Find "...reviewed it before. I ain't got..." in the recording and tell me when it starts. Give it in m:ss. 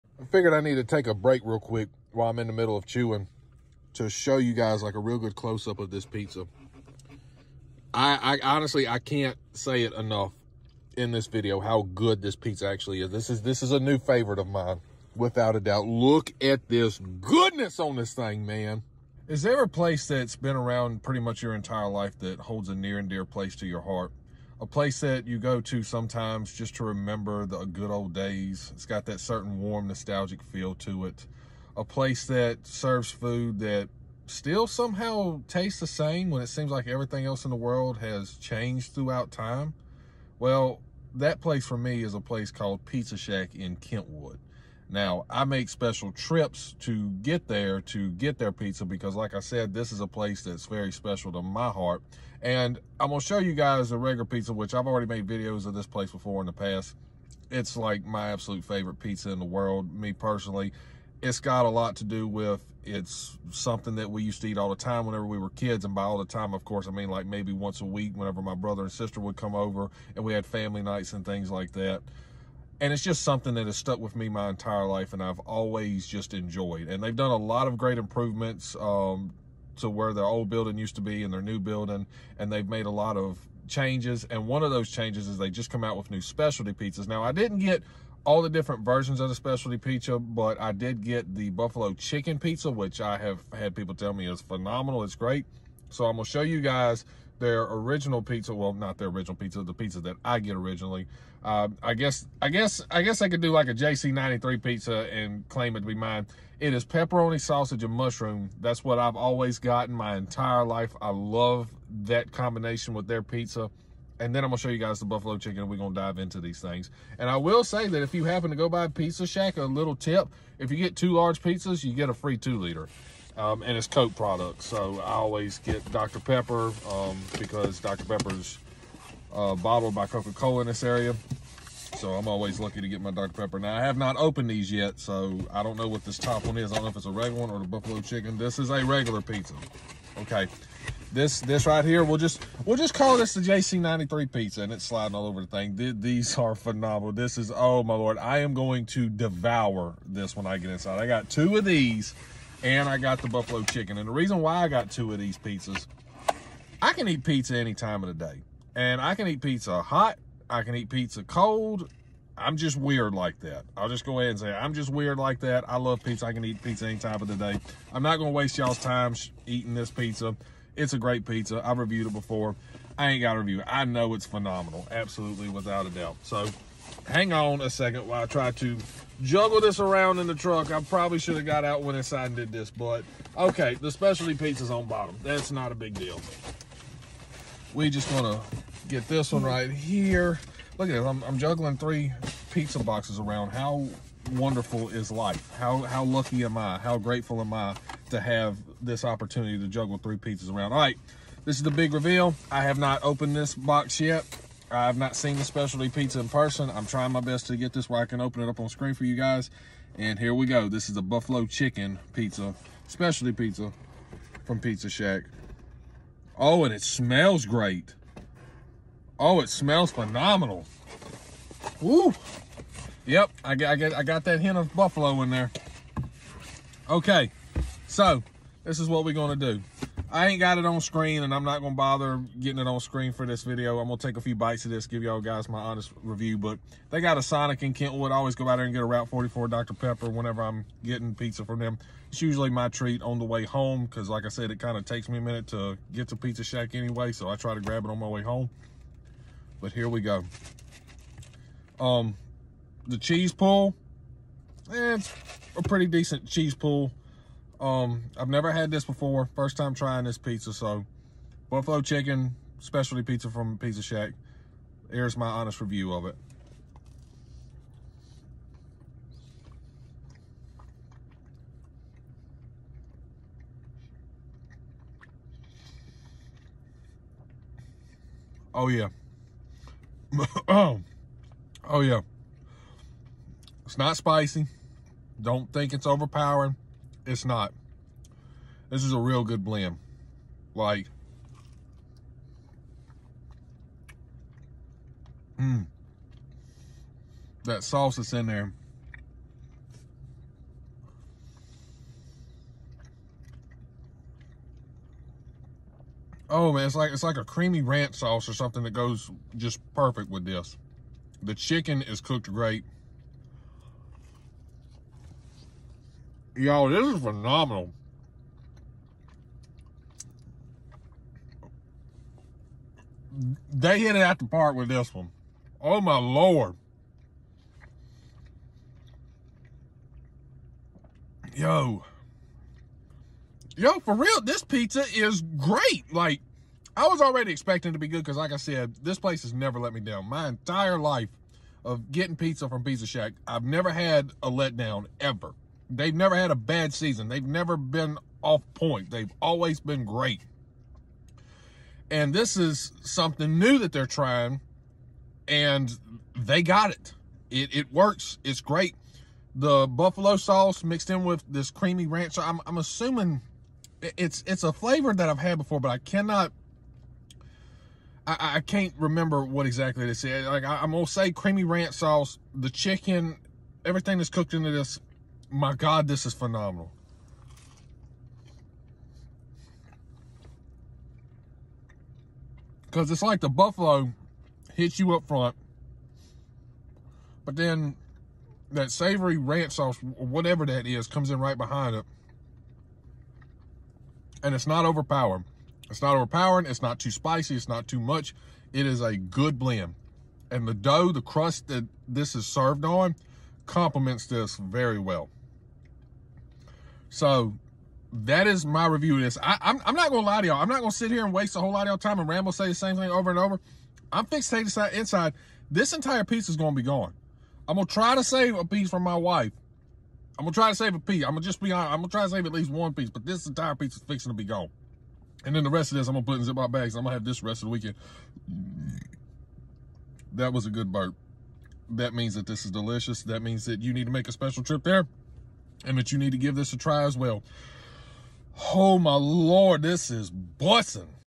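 2:51.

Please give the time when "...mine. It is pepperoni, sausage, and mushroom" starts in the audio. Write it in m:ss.
1:45.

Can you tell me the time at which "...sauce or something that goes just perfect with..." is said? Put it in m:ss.
5:07.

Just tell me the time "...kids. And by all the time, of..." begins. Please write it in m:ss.
1:05.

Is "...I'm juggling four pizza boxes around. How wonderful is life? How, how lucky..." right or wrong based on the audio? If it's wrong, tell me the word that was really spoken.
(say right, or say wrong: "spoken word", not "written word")
wrong: "three", not "four".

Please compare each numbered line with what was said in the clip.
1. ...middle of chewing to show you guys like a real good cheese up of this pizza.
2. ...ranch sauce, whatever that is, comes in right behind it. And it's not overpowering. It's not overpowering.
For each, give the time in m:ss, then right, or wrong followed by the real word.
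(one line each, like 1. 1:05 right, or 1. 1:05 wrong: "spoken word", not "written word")
1. 0:02 wrong: "close", not "cheese"
2. 6:29 right.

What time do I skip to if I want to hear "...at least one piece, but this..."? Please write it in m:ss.
7:02.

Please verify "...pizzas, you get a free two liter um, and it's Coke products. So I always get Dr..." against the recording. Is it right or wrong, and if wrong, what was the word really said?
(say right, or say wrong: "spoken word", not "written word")
right.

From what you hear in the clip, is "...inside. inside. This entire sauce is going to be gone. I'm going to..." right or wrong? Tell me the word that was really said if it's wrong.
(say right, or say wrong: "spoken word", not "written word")
wrong: "piece", not "sauce".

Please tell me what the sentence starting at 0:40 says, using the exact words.
Well, that place for me is a place called Pizza Shack in Kentwood.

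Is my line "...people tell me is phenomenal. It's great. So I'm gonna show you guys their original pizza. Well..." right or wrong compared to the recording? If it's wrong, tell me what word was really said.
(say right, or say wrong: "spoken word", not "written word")
right.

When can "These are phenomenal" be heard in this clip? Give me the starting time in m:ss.
2:25.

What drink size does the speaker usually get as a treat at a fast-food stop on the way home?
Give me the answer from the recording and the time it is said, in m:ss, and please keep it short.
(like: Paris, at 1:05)
Route 44, at 3:58.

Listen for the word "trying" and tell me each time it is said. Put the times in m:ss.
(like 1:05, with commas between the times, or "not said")
3:26, 4:19, 5:53.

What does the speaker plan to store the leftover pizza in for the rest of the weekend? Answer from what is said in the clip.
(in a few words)
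Ziploc bags.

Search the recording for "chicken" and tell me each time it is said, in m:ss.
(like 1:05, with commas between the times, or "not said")
1:31, 1:55, 2:18, 2:33, 3:31, 4:21, 5:11, 6:12.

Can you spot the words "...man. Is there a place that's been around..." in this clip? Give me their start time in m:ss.
0:18.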